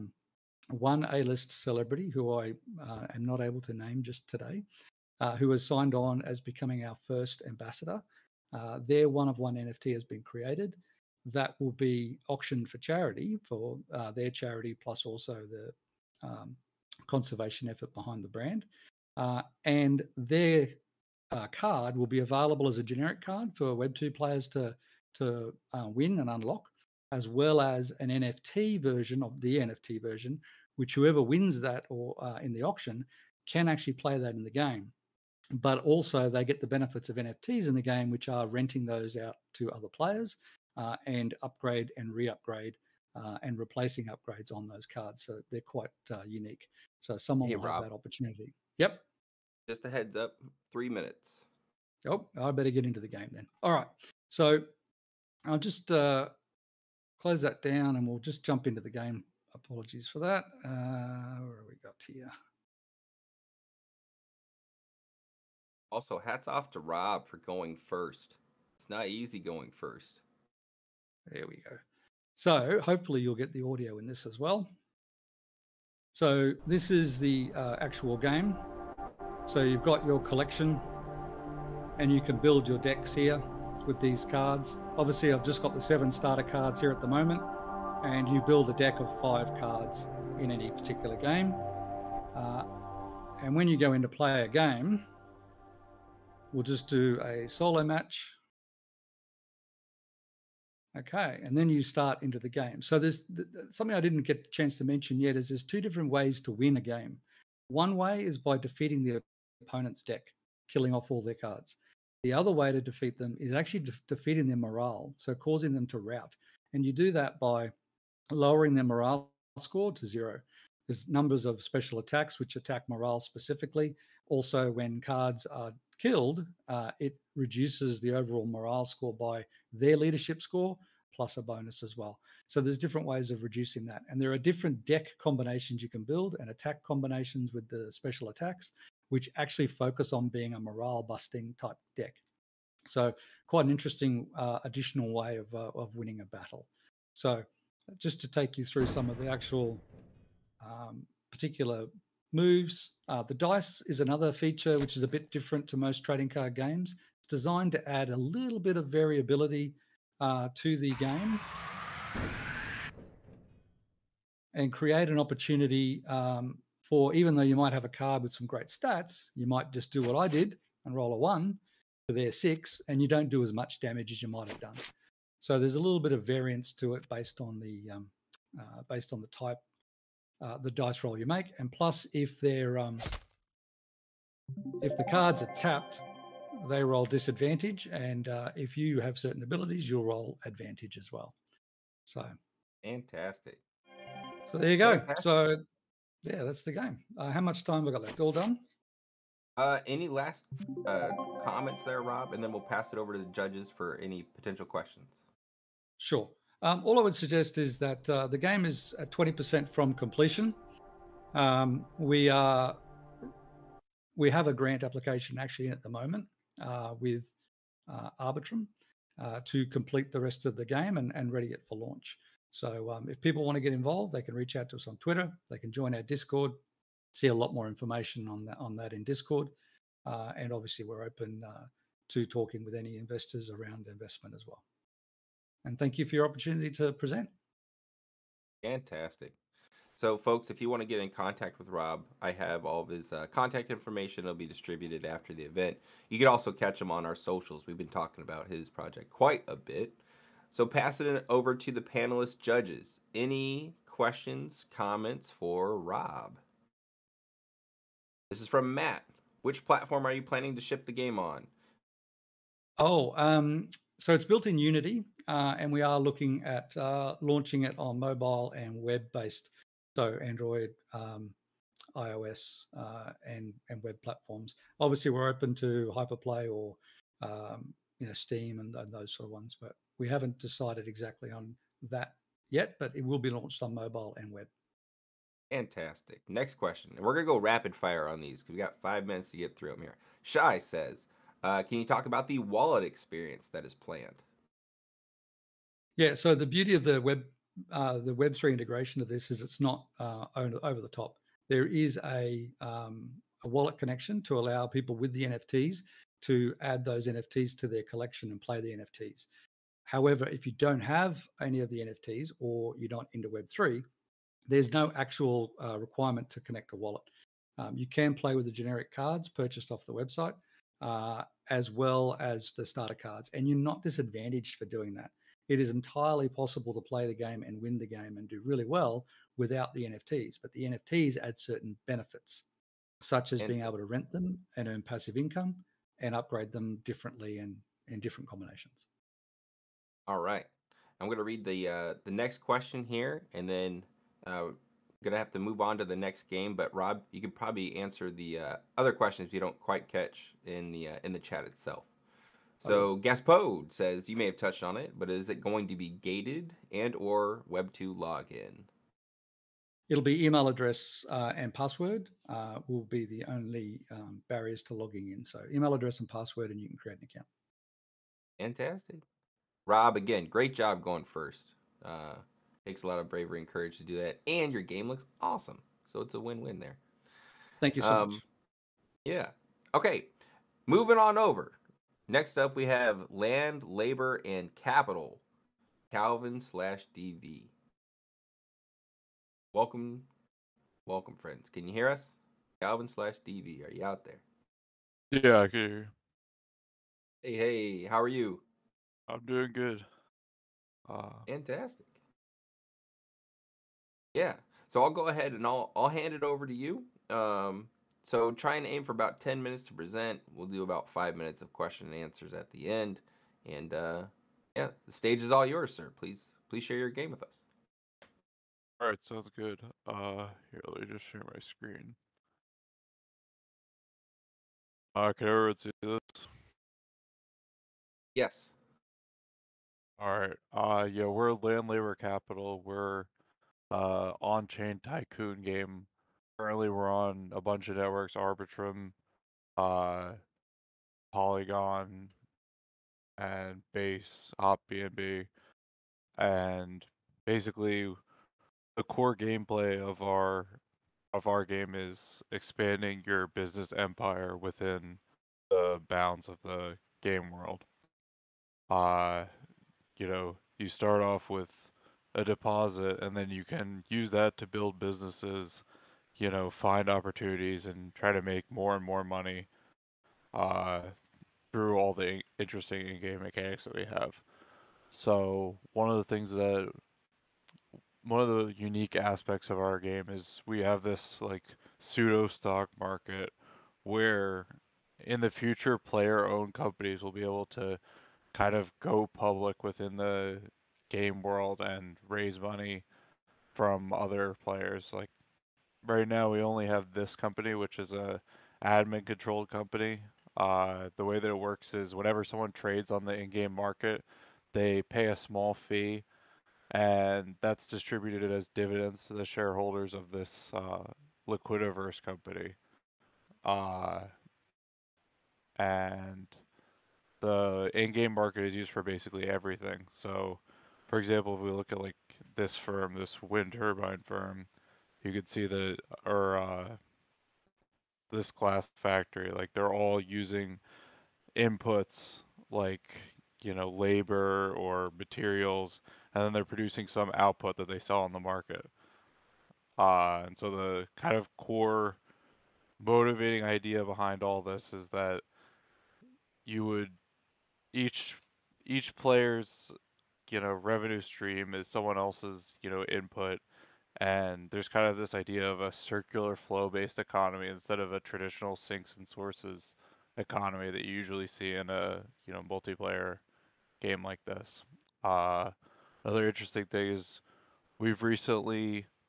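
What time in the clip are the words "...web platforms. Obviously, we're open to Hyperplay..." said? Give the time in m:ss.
4:33.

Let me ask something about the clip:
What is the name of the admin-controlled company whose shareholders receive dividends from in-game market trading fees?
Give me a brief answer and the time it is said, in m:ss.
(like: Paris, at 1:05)
Liquidiverse, at 8:31.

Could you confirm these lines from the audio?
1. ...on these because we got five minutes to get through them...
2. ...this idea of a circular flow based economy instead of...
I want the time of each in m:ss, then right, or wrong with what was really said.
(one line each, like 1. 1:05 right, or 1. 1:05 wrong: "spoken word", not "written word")
1. 4:48 right
2. 9:14 right.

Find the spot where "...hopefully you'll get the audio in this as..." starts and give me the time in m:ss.
1:12.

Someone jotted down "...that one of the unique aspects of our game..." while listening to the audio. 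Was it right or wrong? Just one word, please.
right.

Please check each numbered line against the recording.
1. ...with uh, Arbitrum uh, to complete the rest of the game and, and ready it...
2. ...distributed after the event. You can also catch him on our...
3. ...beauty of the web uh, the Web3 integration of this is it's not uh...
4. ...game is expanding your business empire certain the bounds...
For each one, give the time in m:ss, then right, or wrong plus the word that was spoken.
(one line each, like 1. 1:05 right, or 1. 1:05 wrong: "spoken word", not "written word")
1. 3:37 right
2. 4:04 right
3. 4:56 right
4. 7:31 wrong: "within", not "certain".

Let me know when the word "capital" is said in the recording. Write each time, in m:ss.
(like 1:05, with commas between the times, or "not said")
6:24, 7:11.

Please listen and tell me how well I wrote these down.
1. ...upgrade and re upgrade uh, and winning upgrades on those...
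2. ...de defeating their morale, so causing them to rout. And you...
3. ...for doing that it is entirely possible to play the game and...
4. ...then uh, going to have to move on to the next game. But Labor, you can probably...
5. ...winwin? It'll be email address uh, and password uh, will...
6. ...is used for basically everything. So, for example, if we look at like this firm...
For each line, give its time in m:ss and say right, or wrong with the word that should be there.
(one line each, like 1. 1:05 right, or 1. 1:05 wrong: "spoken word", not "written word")
1. 0:41 wrong: "replacing", not "winning"
2. 1:53 right
3. 5:24 right
4. 5:43 wrong: "Rob", not "Labor"
5. 5:57 wrong: "login", not "winwin"
6. 8:38 right.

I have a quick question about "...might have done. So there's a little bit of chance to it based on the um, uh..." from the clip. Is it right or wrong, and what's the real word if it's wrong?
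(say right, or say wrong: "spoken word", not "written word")
wrong: "variance", not "chance".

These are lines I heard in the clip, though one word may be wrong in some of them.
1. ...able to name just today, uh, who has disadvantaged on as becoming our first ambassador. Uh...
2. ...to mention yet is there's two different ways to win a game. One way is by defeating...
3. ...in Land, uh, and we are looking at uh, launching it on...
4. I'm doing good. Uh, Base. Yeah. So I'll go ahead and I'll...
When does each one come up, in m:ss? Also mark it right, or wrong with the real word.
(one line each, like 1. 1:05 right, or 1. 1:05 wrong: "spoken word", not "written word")
1. 0:03 wrong: "signed", not "disadvantaged"
2. 1:44 right
3. 4:24 wrong: "Unity", not "Land"
4. 6:39 wrong: "Fantastic", not "Base".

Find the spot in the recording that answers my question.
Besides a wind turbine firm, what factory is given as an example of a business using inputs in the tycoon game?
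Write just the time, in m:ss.
8:48.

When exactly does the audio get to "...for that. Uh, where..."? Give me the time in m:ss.
1:00.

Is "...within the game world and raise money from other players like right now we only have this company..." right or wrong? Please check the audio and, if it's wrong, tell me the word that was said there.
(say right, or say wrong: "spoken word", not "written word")
right.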